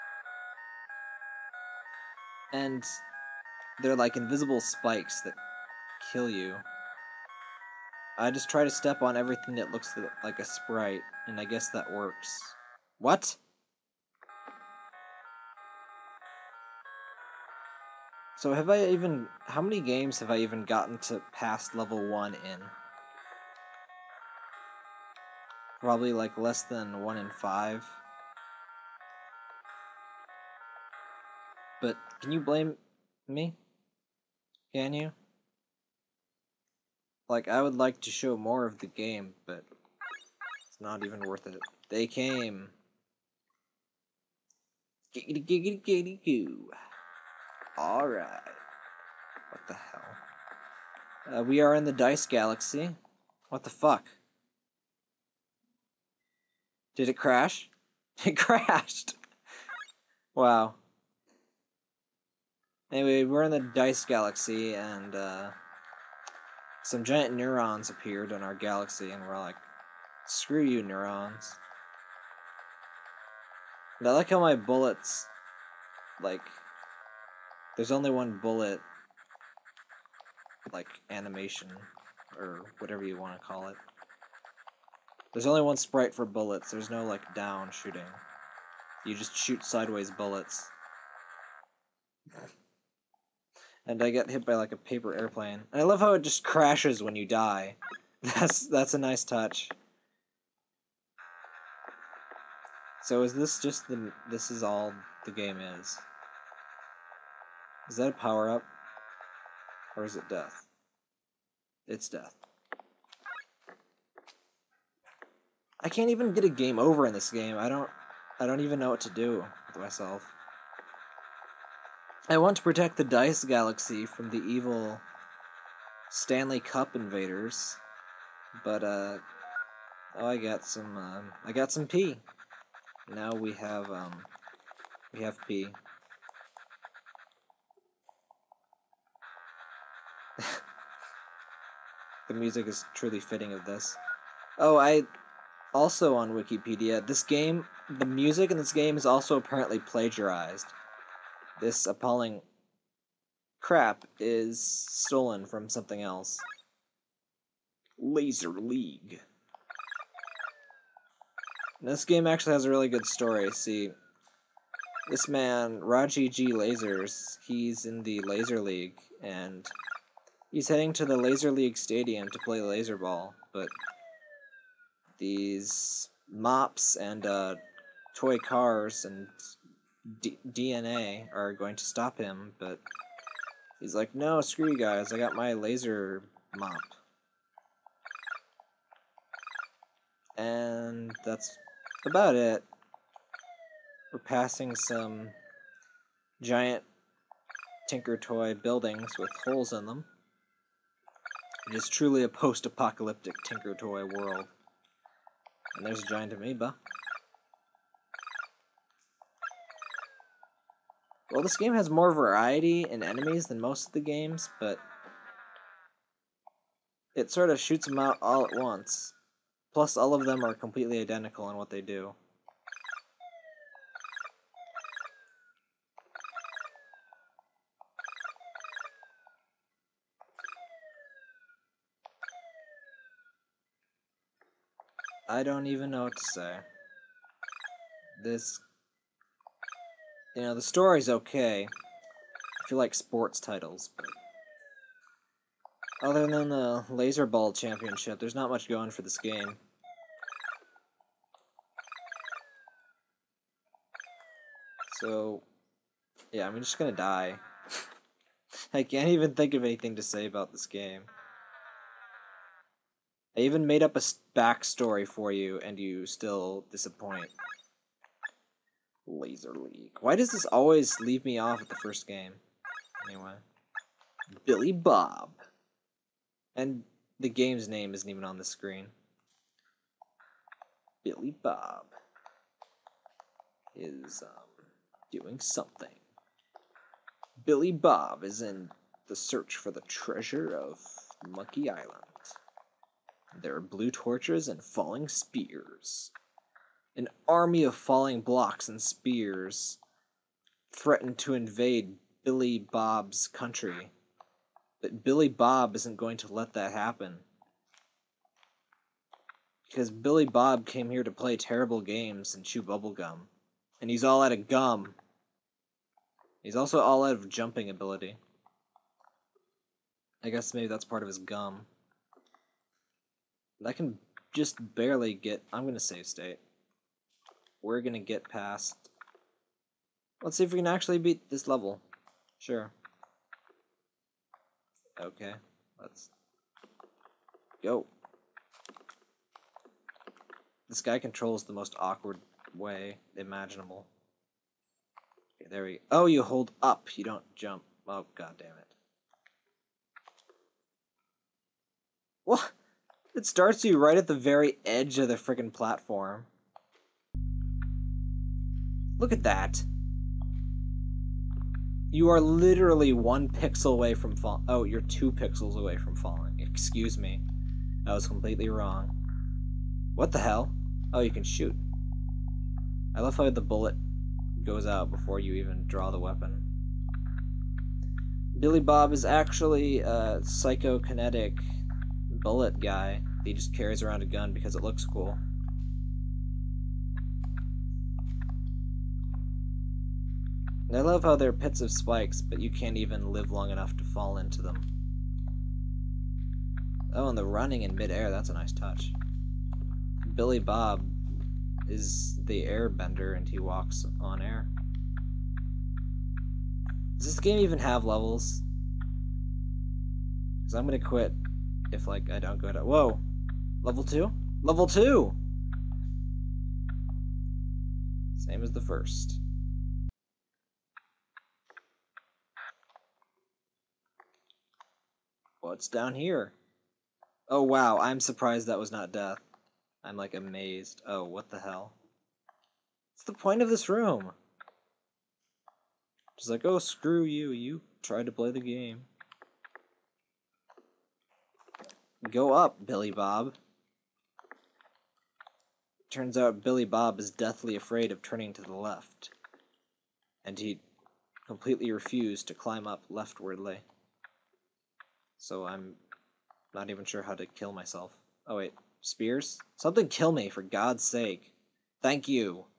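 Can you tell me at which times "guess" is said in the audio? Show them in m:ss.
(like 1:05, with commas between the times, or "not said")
0:11, 5:20.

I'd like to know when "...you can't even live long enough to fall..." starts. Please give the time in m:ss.
6:32.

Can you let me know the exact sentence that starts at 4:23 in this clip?
I even made up a backstory for you, and you still disappoint.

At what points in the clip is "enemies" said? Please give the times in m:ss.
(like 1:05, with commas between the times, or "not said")
3:33.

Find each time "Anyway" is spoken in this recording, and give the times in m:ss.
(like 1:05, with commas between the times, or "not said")
1:02, 4:33.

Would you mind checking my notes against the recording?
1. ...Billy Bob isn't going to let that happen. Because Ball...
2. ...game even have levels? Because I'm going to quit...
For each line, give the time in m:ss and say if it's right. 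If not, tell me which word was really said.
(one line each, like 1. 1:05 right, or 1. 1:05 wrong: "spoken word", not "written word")
1. 5:05 wrong: "Billy", not "Ball"
2. 6:47 right.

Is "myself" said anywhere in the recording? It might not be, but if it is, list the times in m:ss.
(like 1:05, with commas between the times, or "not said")
1:59, 7:37.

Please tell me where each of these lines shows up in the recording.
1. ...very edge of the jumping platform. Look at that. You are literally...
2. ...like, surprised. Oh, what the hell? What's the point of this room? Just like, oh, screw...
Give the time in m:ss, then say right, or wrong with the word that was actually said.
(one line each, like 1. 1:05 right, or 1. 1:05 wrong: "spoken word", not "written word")
1. 5:54 wrong: "freaking", not "jumping"
2. 7:09 wrong: "amazed", not "surprised".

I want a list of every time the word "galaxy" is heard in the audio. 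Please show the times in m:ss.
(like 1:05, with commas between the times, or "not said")
0:52, 1:04, 1:08, 2:03.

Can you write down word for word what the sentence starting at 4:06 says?
Other than the Laser Ball Championship, there's not much going for this game.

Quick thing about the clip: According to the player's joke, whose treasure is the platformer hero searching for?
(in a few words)
Monkey Island.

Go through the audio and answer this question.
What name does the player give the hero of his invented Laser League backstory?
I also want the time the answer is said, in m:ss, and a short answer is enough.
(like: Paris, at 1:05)
Raji G. Lasers, at 2:45.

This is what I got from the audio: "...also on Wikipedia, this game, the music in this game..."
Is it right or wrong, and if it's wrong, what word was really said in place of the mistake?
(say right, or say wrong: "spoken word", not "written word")
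right.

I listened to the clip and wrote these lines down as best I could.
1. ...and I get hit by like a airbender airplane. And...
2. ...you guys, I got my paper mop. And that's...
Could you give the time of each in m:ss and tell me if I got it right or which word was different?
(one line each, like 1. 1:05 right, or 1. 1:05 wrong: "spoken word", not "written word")
1. 1:33 wrong: "paper", not "airbender"
2. 3:04 wrong: "laser", not "paper".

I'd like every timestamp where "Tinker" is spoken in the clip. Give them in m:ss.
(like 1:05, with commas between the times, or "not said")
3:17, 3:23.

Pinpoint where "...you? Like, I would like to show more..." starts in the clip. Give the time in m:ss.
0:34.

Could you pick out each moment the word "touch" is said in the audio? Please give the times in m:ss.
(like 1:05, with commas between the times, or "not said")
1:39, 6:38.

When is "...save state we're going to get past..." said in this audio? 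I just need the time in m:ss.
5:25.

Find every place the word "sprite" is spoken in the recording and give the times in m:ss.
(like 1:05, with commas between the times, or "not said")
0:10, 1:25.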